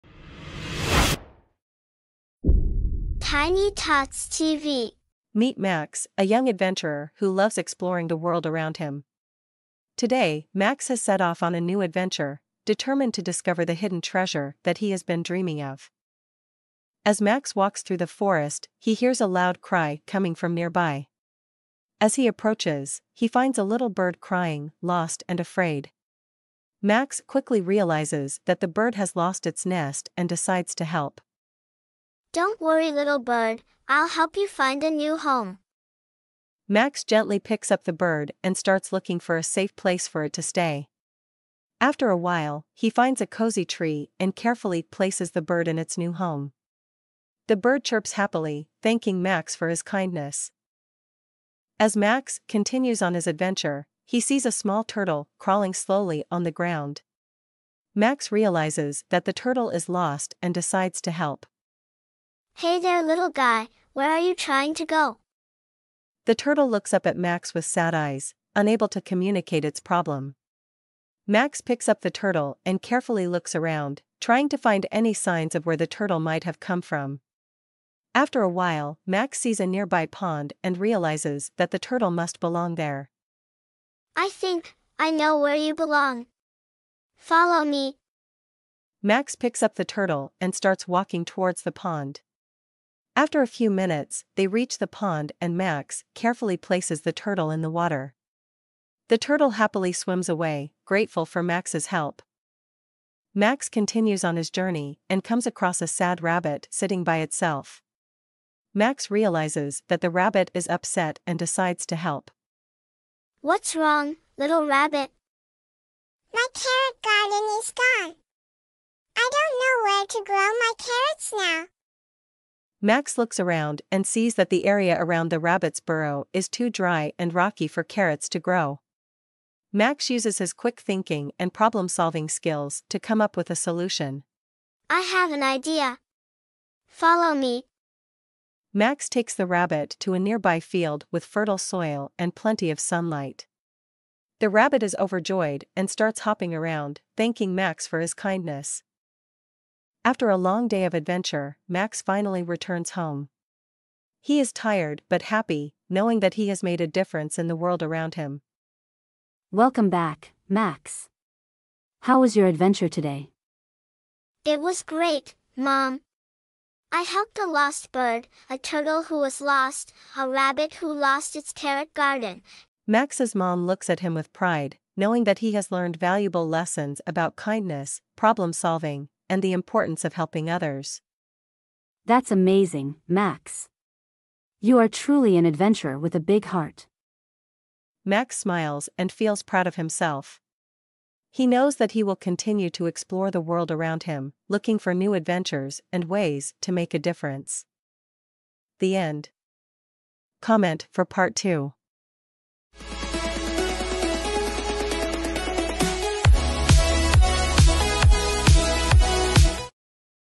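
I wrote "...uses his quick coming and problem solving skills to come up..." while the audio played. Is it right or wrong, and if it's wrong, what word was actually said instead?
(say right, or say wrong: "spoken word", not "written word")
wrong: "thinking", not "coming".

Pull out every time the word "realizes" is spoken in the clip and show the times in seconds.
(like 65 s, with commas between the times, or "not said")
27 s, 58 s, 80 s, 109 s.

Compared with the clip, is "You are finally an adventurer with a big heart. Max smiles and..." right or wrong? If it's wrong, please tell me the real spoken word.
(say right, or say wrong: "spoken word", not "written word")
wrong: "truly", not "finally".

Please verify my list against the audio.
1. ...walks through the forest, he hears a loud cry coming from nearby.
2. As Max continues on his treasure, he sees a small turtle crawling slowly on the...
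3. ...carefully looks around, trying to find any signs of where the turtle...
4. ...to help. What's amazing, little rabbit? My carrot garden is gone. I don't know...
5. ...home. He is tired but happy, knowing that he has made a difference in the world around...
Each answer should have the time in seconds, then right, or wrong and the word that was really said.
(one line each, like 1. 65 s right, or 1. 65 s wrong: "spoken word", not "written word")
1. 17 s right
2. 51 s wrong: "adventure", not "treasure"
3. 72 s right
4. 111 s wrong: "wrong", not "amazing"
5. 152 s right.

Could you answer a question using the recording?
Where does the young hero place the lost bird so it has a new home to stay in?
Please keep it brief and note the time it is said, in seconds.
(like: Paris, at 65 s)
a cozy tree, at 43 s.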